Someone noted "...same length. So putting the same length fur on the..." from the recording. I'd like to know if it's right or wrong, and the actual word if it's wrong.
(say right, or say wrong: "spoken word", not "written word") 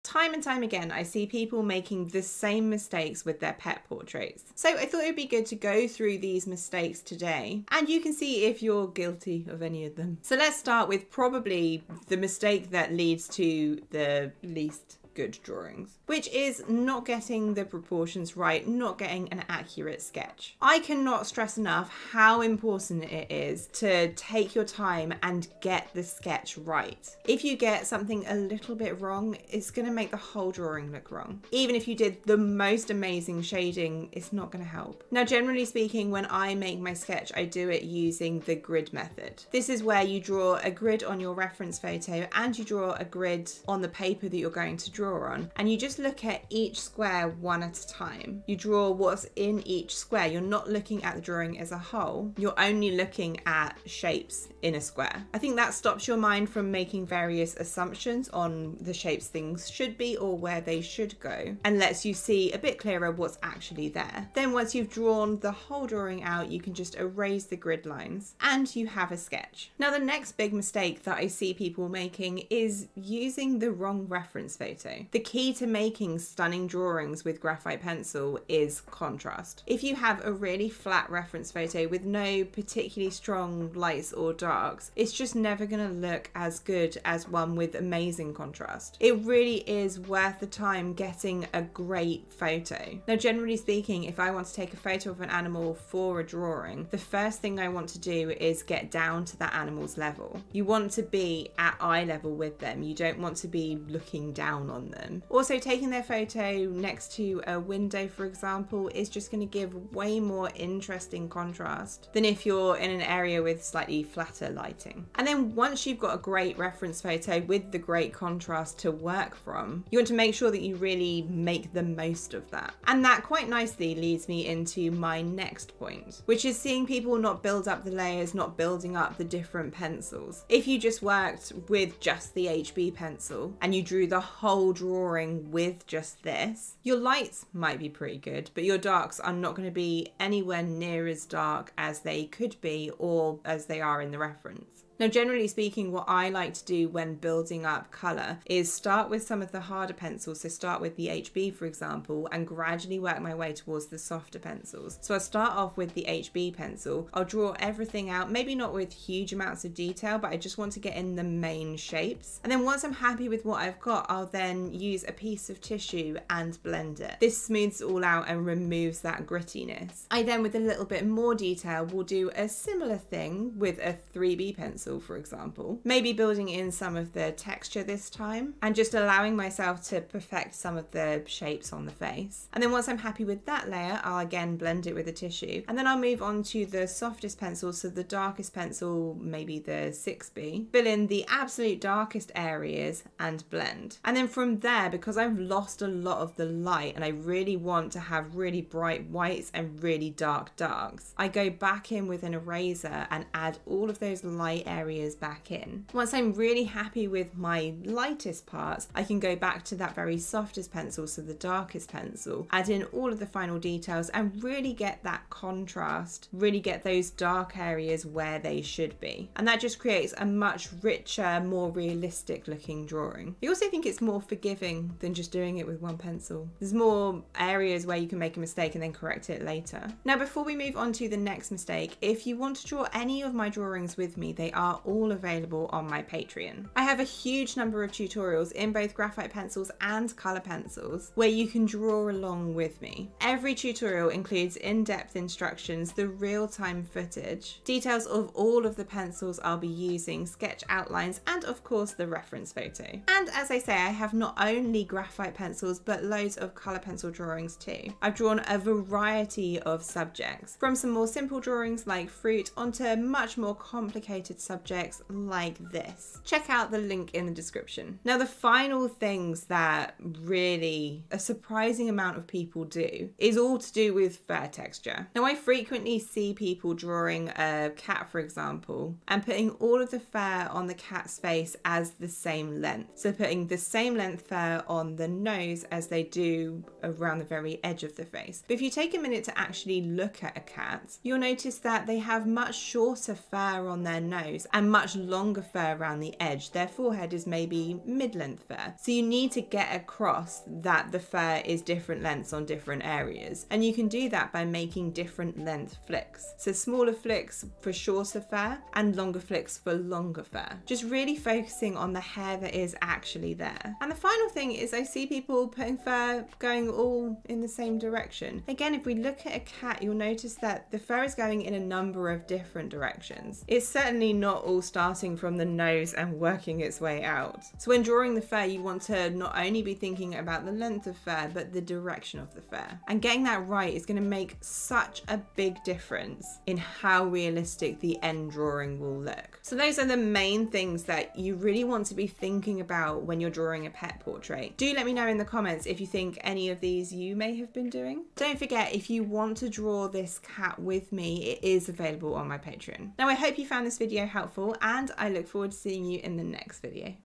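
right.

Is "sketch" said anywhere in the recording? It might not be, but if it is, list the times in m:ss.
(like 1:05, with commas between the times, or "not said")
0:20, 0:26, 0:36, 1:09, 4:10.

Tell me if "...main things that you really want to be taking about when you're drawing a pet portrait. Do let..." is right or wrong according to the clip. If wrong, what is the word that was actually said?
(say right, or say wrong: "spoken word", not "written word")
wrong: "thinking", not "taking".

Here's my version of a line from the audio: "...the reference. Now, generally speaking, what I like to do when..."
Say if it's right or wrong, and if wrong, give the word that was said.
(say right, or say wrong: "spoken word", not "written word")
right.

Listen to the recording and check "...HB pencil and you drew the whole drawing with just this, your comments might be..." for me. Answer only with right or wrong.
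wrong.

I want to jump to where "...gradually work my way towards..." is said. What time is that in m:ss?
2:32.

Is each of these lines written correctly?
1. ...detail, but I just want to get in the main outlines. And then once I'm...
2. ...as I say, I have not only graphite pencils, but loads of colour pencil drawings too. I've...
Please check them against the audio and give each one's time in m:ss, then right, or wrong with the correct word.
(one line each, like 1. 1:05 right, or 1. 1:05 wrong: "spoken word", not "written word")
1. 2:39 wrong: "shapes", not "outlines"
2. 4:13 right.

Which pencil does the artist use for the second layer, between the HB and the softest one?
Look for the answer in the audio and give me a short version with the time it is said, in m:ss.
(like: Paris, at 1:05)
3B, at 2:54.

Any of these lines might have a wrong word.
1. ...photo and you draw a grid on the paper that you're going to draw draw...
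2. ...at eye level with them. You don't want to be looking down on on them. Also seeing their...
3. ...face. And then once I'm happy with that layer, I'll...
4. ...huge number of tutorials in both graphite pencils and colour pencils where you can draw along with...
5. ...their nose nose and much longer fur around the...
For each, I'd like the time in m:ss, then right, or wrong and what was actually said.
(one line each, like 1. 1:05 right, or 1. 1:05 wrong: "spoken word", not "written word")
1. 0:41 right
2. 1:41 wrong: "taking", not "seeing"
3. 3:01 right
4. 3:57 right
5. 4:53 right.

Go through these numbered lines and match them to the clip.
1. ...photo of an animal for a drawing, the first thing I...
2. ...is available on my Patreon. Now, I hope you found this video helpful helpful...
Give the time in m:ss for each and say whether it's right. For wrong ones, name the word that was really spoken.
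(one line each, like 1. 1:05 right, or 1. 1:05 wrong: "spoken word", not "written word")
1. 1:34 right
2. 5:51 right.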